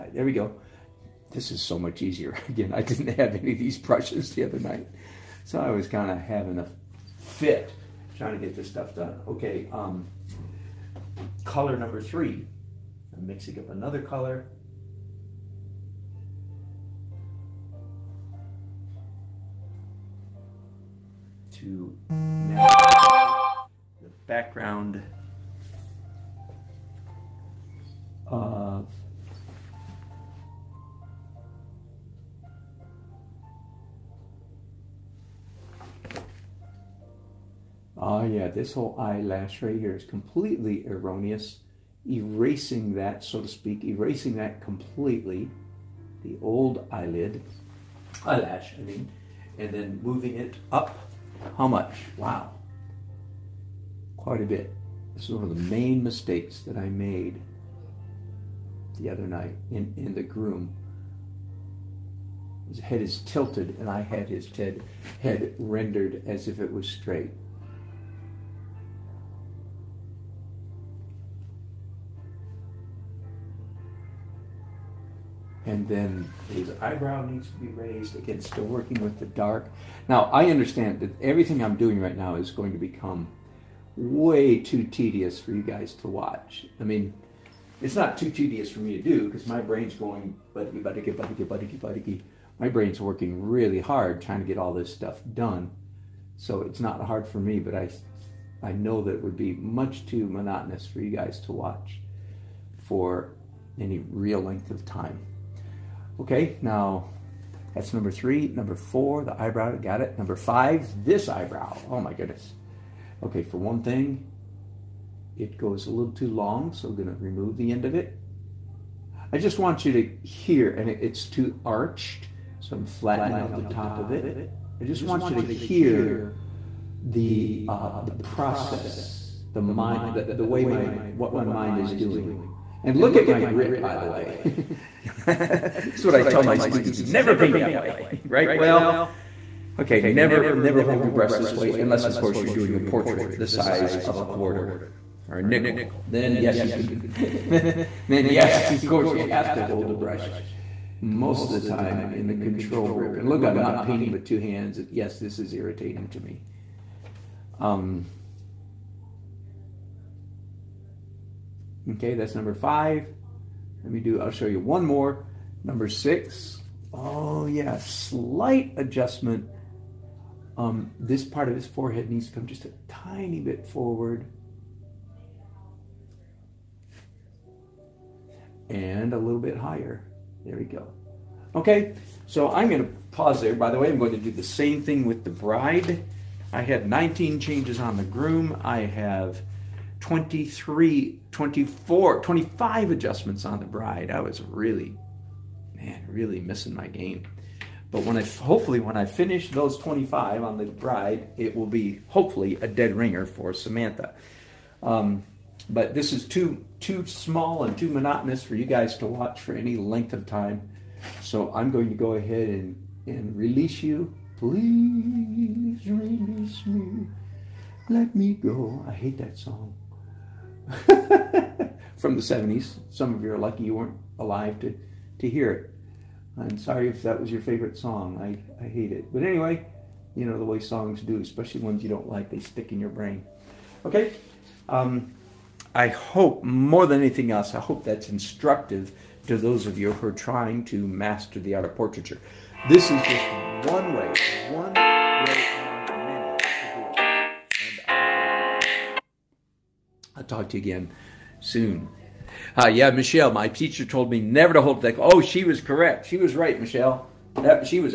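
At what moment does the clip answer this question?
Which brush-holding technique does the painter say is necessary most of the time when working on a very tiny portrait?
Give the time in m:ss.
2:32.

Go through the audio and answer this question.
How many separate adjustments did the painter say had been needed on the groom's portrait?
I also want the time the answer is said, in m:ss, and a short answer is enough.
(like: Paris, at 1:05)
19, at 3:06.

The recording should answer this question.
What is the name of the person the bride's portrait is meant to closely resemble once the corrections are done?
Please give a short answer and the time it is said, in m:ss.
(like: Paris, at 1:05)
Samantha, at 3:23.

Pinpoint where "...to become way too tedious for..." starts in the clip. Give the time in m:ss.
1:22.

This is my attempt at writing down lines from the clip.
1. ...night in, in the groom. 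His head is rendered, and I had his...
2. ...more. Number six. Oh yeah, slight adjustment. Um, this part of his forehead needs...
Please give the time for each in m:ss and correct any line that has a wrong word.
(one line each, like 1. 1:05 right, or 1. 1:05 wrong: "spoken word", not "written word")
1. 0:59 wrong: "tilted", not "rendered"
2. 2:44 right.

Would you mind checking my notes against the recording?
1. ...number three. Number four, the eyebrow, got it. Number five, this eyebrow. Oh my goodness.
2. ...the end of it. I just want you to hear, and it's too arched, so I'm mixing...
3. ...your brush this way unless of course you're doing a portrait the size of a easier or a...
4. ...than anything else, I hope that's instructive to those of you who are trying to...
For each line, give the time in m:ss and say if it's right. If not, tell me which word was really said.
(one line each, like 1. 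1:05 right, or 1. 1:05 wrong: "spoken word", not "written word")
1. 1:47 right
2. 1:57 wrong: "flattening", not "mixing"
3. 2:21 wrong: "quarter", not "easier"
4. 3:56 right.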